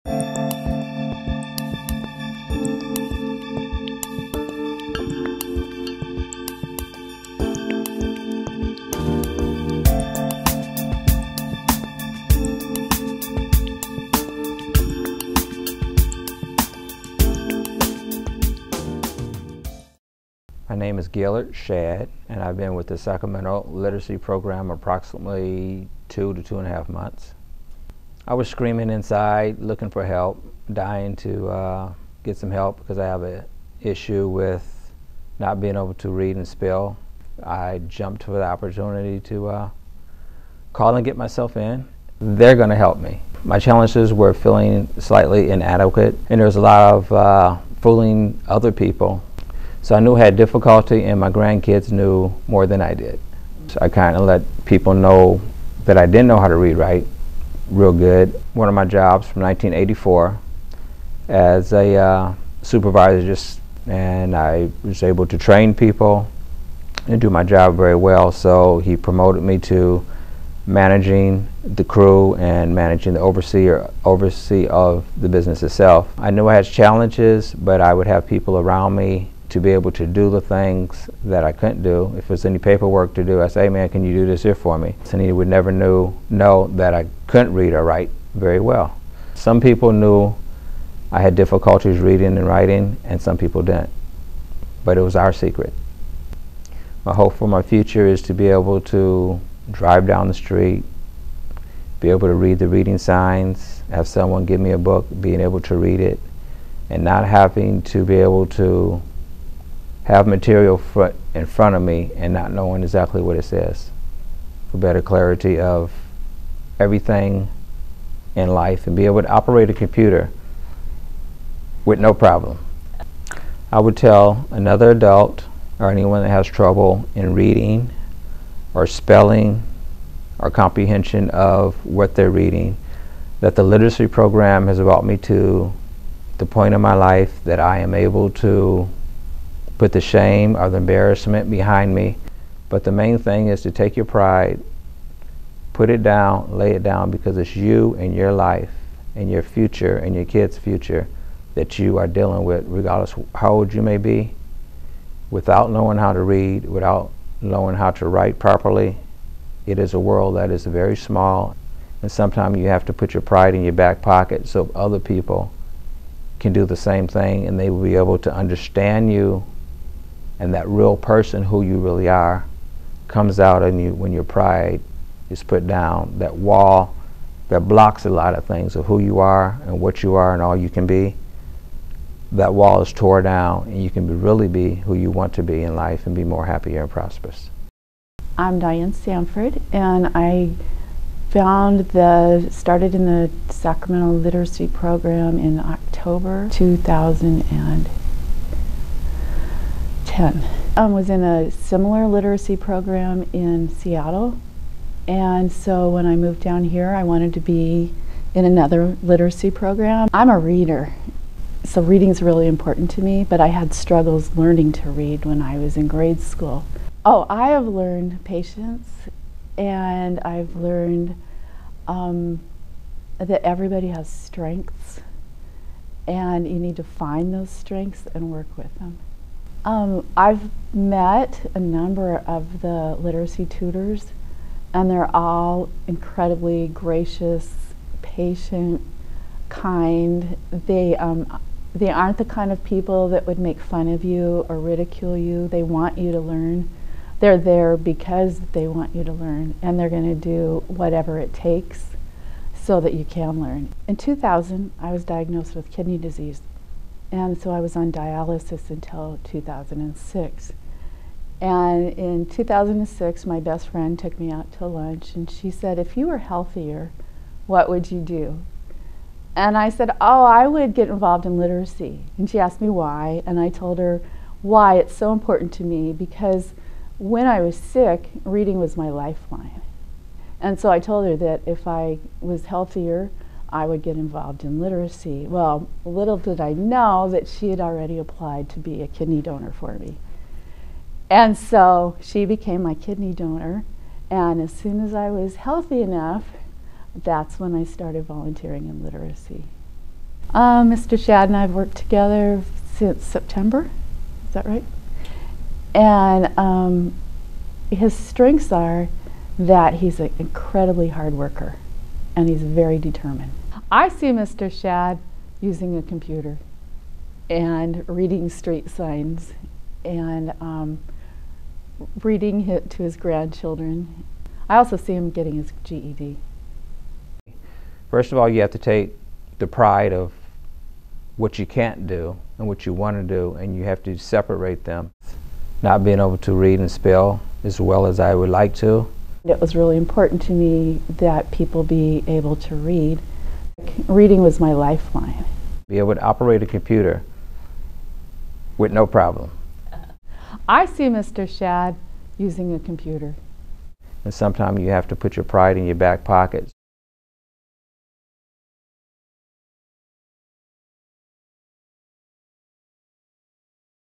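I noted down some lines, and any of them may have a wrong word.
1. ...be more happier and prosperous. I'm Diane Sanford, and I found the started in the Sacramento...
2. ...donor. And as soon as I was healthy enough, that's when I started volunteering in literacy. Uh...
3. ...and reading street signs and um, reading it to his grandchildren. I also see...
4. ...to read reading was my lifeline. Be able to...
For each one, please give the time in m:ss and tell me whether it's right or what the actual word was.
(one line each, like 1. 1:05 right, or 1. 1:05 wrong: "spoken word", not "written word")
1. 3:06 right
2. 4:53 right
3. 5:17 right
4. 5:42 right.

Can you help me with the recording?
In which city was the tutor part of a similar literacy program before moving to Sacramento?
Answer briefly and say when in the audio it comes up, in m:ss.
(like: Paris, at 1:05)
Seattle, at 3:23.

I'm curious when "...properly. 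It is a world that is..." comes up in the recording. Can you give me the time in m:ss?
2:38.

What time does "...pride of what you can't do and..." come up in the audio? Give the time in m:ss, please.
5:29.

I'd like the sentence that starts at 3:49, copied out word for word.
Um, I've met a number of the literacy tutors, and they're all incredibly gracious, patient, kind.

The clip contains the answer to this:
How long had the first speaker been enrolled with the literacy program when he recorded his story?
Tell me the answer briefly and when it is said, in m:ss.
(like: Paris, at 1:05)
2 to 2.5 months, at 0:26.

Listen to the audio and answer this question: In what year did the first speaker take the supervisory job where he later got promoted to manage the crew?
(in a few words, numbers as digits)
1984.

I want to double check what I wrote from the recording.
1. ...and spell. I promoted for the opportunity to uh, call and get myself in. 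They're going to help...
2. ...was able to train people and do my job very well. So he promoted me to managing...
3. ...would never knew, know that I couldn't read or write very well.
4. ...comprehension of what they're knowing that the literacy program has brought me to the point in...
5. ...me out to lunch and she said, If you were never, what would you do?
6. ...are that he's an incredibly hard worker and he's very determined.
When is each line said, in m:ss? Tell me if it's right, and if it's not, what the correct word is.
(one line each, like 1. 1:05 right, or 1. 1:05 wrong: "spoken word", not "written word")
1. 0:36 wrong: "jumped", not "promoted"
2. 1:04 right
3. 1:25 right
4. 2:10 wrong: "reading", not "knowing"
5. 4:24 wrong: "healthier", not "never"
6. 5:08 right.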